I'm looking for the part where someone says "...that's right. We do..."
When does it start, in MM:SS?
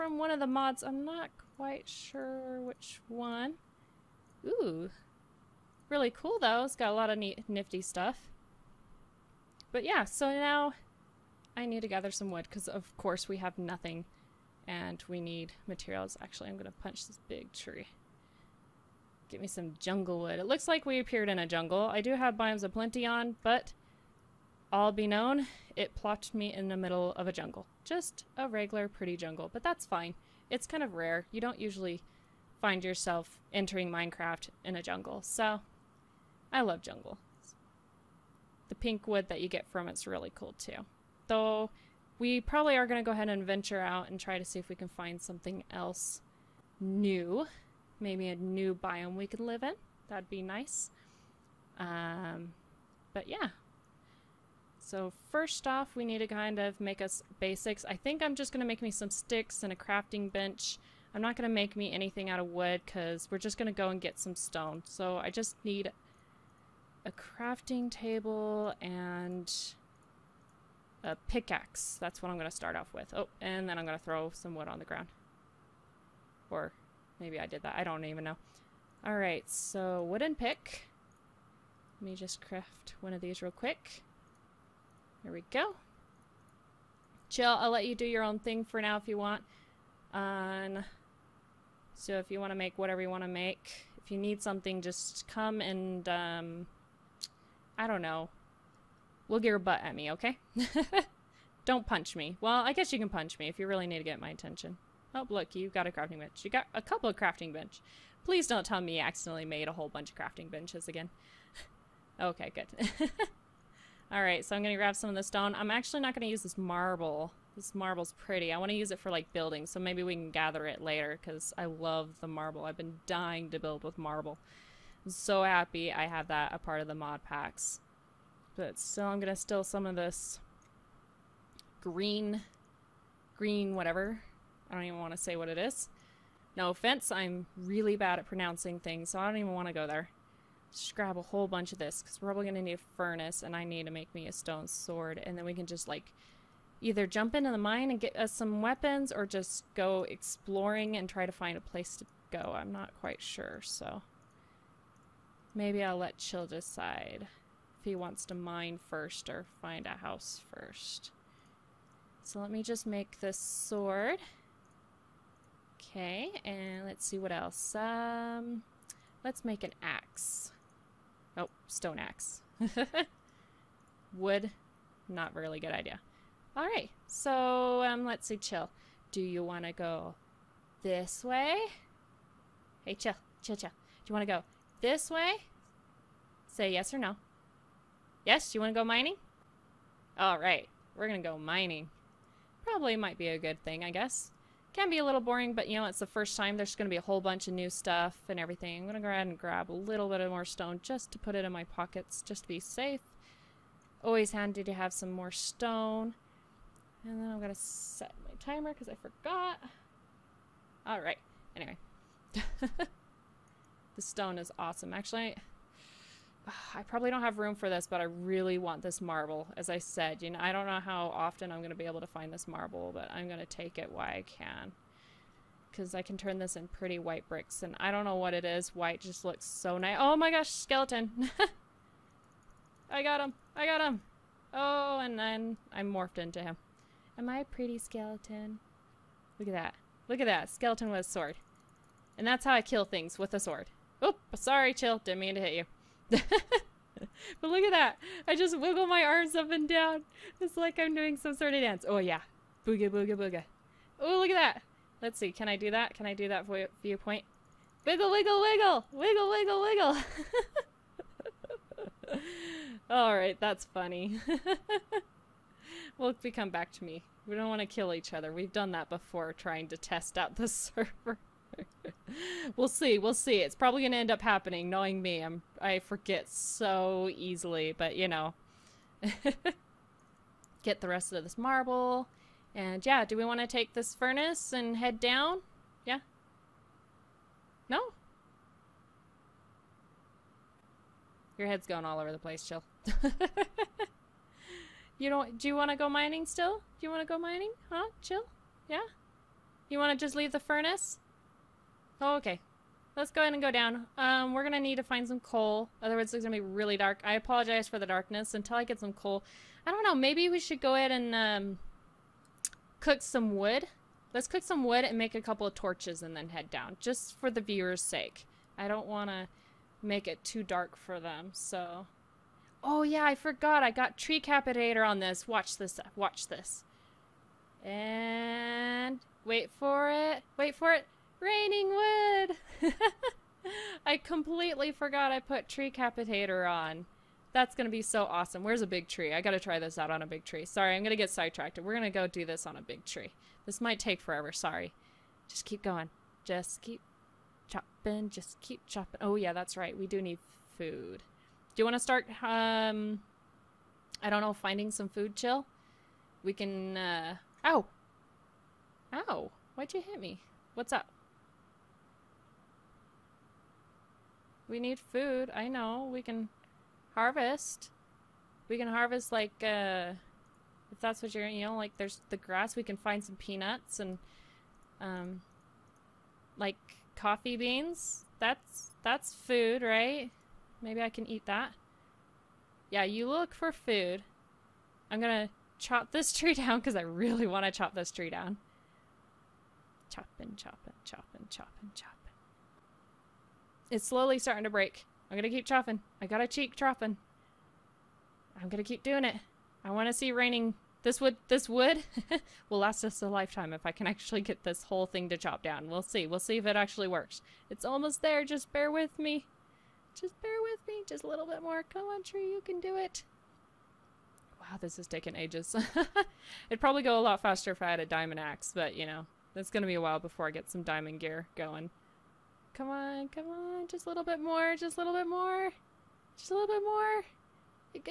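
05:49.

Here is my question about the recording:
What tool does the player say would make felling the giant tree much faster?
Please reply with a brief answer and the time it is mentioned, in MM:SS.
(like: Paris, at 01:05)
diamond axe, at 06:57.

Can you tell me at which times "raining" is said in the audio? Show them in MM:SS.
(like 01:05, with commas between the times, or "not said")
05:31, 06:40.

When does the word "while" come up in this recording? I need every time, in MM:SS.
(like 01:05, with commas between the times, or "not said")
03:43, 06:59.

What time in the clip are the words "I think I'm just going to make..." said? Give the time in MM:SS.
00:57.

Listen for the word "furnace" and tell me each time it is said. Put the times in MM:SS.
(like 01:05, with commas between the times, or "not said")
02:22, 04:43, 05:00.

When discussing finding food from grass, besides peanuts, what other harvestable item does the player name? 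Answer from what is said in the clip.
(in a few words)
coffee beans.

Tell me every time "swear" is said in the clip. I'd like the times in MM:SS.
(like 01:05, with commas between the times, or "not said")
not said.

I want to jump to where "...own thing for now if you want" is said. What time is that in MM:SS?
01:28.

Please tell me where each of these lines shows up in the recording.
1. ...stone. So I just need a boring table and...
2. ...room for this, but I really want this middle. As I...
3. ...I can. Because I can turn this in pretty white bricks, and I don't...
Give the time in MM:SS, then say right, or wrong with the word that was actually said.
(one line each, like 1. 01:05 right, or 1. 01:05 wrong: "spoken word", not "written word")
1. 01:04 wrong: "crafting", not "boring"
2. 03:37 wrong: "marble", not "middle"
3. 03:44 right.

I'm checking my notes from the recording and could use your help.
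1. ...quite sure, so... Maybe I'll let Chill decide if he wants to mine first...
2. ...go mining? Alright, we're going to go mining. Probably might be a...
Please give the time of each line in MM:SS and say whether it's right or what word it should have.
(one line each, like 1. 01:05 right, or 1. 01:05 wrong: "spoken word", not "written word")
1. 02:32 right
2. 03:08 right.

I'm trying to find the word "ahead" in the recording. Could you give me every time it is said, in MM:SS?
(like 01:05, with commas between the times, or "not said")
00:43, 03:19, 05:03, 05:10.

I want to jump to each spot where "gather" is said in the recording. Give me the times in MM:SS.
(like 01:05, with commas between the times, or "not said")
00:11, 02:00.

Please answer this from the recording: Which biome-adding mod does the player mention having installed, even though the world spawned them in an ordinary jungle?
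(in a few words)
Biomes O Plenty.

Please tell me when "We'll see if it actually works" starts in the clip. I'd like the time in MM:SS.
06:46.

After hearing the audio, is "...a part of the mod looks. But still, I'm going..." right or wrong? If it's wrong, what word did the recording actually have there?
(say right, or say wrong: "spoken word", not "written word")
wrong: "packs", not "looks".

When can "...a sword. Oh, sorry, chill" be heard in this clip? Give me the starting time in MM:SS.
04:03.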